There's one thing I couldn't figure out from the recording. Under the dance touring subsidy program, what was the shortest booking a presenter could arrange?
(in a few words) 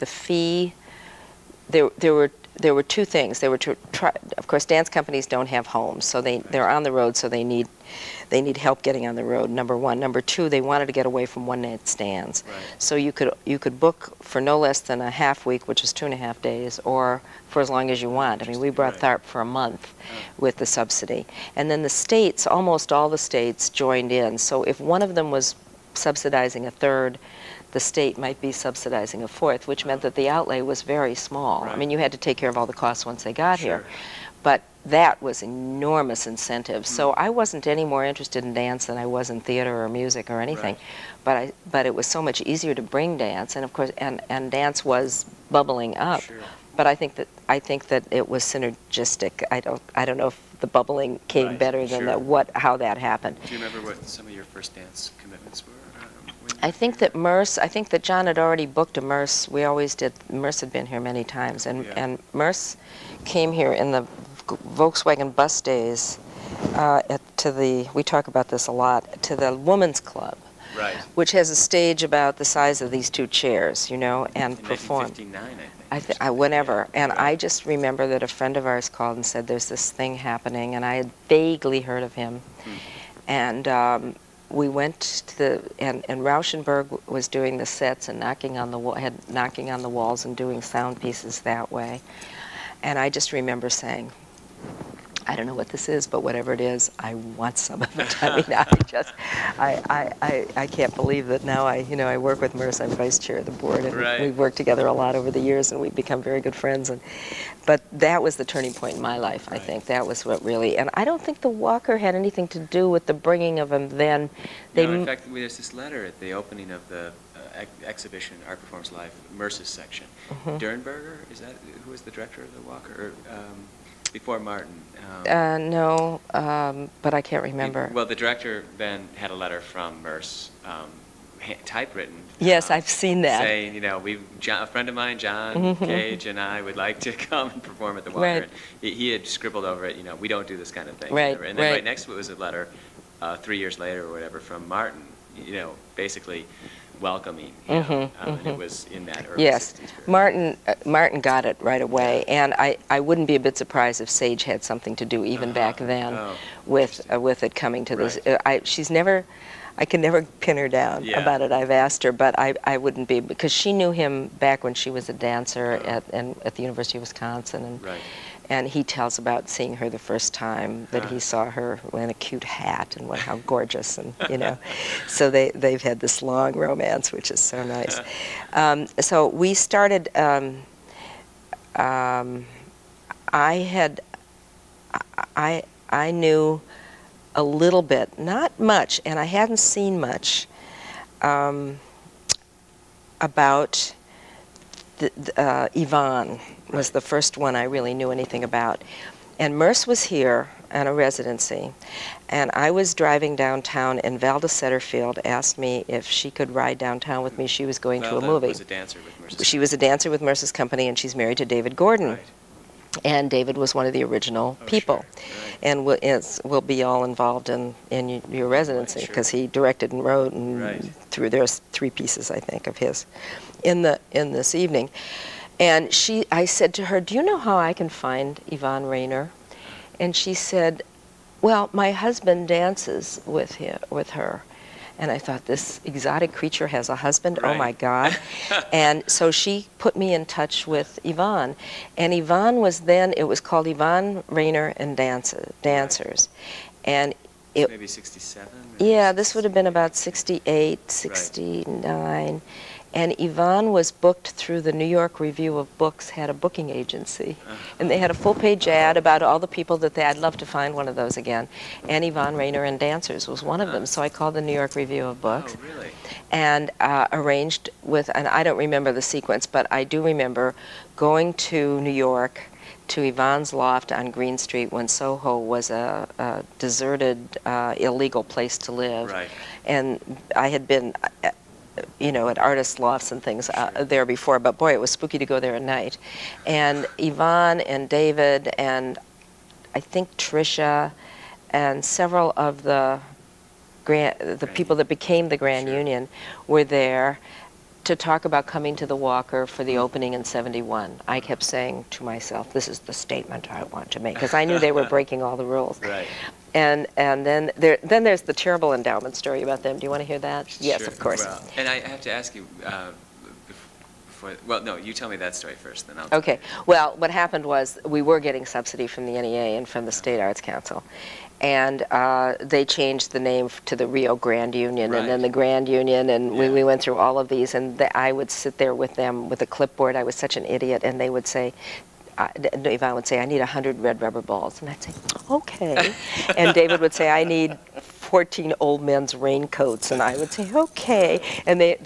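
half week.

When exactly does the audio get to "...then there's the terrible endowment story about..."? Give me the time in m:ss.
5:07.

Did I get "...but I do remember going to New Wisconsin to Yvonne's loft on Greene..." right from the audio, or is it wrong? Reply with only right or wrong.
wrong.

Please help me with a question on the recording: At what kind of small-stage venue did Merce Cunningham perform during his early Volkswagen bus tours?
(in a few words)
women's club.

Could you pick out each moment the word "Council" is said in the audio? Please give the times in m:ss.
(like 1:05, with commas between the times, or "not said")
5:20.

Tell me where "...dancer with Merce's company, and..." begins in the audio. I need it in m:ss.
3:29.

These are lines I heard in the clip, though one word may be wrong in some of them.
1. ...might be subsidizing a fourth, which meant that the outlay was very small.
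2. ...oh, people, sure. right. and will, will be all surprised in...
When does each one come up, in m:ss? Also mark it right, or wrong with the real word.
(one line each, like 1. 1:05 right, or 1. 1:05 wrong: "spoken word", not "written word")
1. 0:28 right
2. 3:34 wrong: "involved", not "surprised".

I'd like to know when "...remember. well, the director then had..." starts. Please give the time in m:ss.
2:07.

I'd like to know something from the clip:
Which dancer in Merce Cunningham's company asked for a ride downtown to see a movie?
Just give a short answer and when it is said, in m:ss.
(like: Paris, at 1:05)
Valda Setterfield, at 3:24.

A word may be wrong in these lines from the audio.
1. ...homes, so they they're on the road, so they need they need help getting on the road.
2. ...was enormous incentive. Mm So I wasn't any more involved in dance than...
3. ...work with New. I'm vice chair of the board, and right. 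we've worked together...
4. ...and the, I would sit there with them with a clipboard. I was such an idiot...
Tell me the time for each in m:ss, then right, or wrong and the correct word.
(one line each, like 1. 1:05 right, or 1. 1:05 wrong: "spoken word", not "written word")
1. 0:05 right
2. 0:35 wrong: "interested", not "involved"
3. 1:42 wrong: "Merce", not "New"
4. 5:27 right.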